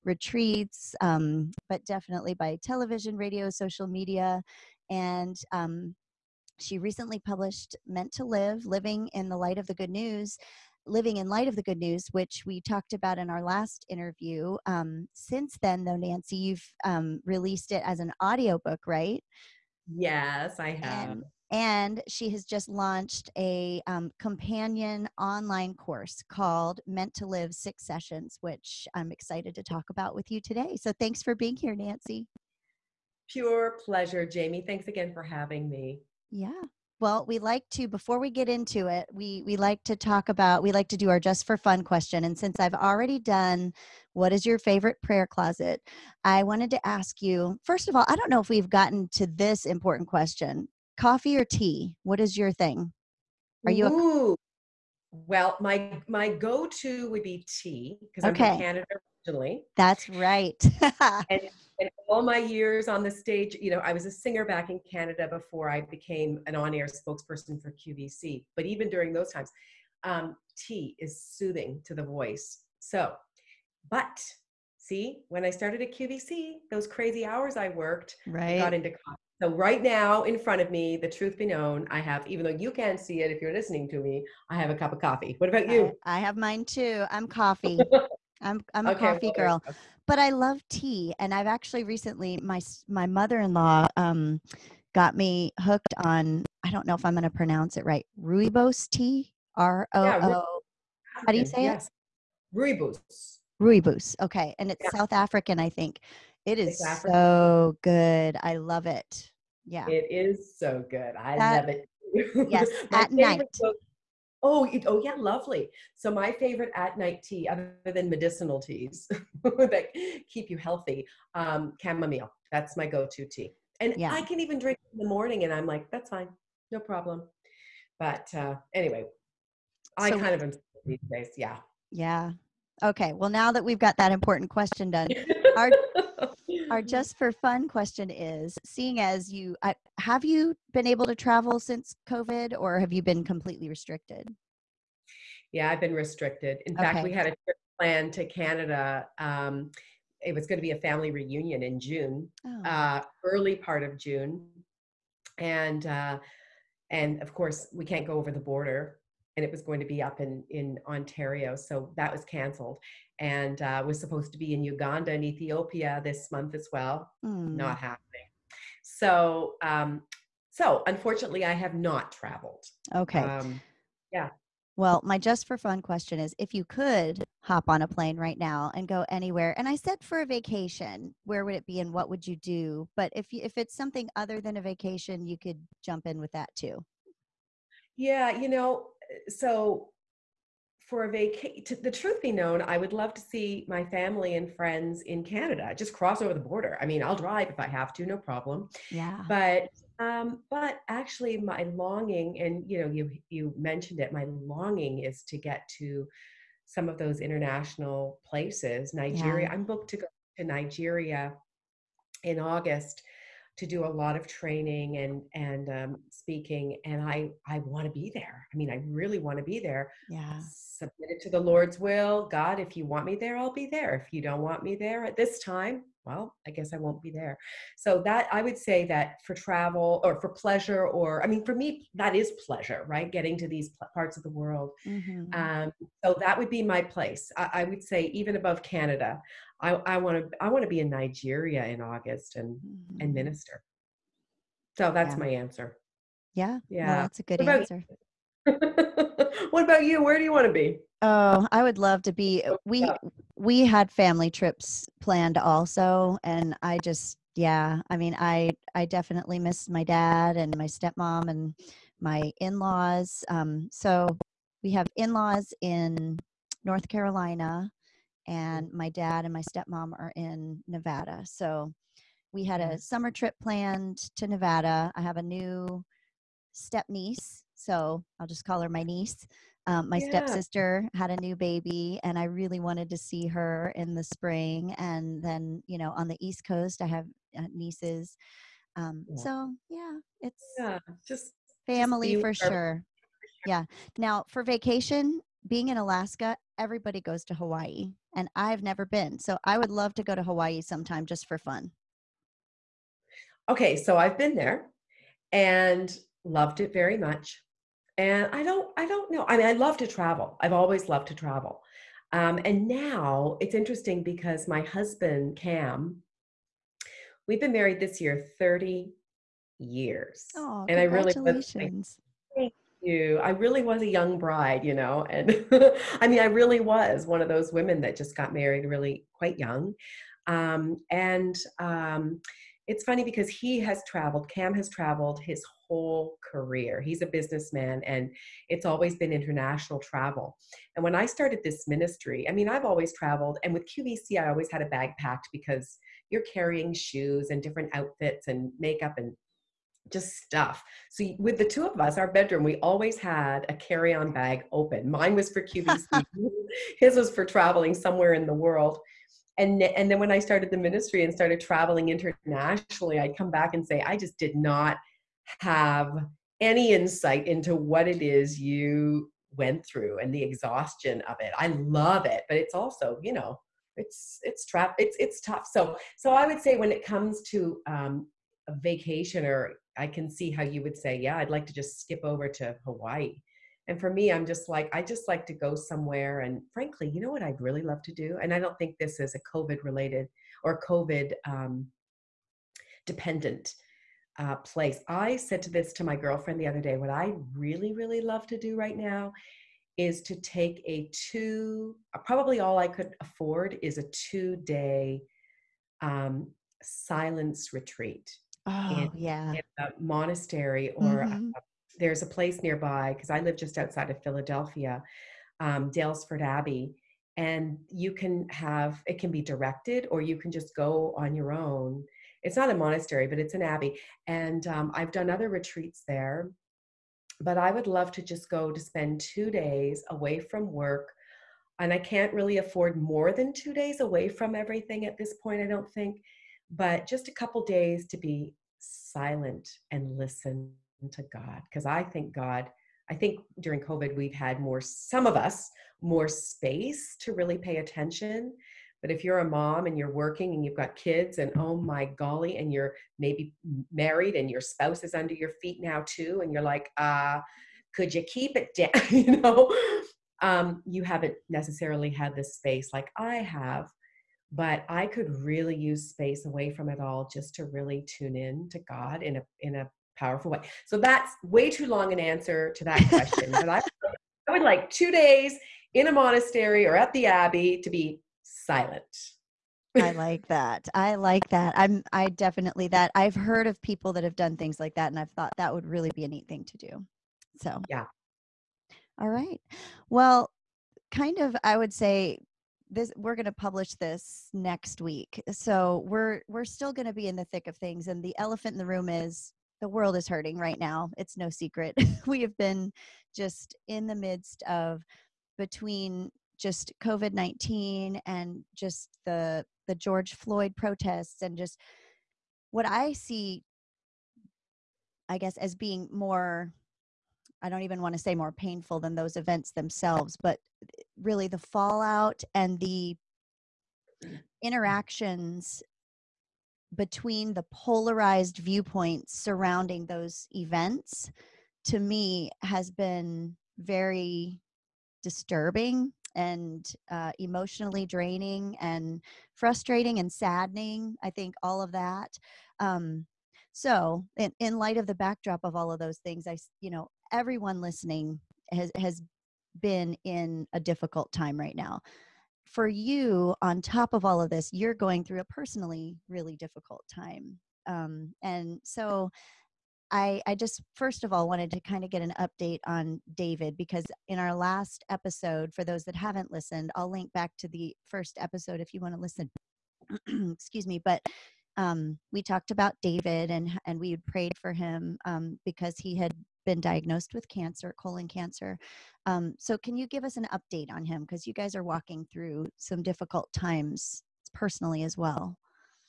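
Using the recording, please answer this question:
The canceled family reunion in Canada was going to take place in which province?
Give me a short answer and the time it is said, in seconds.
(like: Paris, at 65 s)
Ontario, at 160 s.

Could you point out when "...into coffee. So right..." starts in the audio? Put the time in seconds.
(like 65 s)
78 s.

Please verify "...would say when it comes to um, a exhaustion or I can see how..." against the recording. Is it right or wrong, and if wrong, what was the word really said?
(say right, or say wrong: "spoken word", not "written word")
wrong: "vacation", not "exhaustion".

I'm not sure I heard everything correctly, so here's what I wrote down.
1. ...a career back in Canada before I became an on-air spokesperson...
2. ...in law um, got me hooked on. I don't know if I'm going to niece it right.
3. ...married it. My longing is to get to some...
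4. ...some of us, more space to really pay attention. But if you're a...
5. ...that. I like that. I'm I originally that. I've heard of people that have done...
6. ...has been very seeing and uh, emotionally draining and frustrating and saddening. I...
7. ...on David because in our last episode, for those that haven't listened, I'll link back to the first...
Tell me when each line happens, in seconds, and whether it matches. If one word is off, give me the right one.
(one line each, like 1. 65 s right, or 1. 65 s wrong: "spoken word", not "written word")
1. 64 s wrong: "singer", not "career"
2. 93 s wrong: "pronounce", not "niece"
3. 203 s wrong: "mentioned", not "married"
4. 444 s right
5. 480 s wrong: "definitely", not "originally"
6. 532 s wrong: "disturbing", not "seeing"
7. 562 s right.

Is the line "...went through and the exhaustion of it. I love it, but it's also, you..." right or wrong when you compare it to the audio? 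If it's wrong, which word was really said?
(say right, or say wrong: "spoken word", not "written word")
right.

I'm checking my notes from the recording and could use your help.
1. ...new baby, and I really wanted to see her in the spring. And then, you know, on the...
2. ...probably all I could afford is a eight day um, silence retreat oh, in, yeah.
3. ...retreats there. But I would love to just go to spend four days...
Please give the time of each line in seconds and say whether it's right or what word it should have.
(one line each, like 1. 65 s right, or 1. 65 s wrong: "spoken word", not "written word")
1. 281 s right
2. 402 s wrong: "two", not "eight"
3. 425 s wrong: "two", not "four".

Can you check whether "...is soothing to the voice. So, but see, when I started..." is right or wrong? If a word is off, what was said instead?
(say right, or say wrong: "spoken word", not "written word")
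right.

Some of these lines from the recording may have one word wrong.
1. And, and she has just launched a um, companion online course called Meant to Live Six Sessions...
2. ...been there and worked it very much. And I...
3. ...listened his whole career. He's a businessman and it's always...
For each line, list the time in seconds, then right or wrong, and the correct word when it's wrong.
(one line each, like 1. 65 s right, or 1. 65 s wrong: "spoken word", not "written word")
1. 21 s right
2. 304 s wrong: "loved", not "worked"
3. 334 s wrong: "traveled", not "listened".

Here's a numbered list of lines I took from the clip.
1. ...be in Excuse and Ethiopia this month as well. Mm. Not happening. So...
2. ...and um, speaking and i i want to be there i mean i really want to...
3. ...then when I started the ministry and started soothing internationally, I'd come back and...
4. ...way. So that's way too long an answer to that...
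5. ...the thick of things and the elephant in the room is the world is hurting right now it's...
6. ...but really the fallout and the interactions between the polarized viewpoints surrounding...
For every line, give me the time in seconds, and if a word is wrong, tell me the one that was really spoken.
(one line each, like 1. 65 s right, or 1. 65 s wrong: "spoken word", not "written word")
1. 164 s wrong: "Uganda", not "Excuse"
2. 215 s right
3. 359 s wrong: "traveling", not "soothing"
4. 470 s right
5. 497 s right
6. 520 s right.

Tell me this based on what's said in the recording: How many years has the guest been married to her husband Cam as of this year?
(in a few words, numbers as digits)
30.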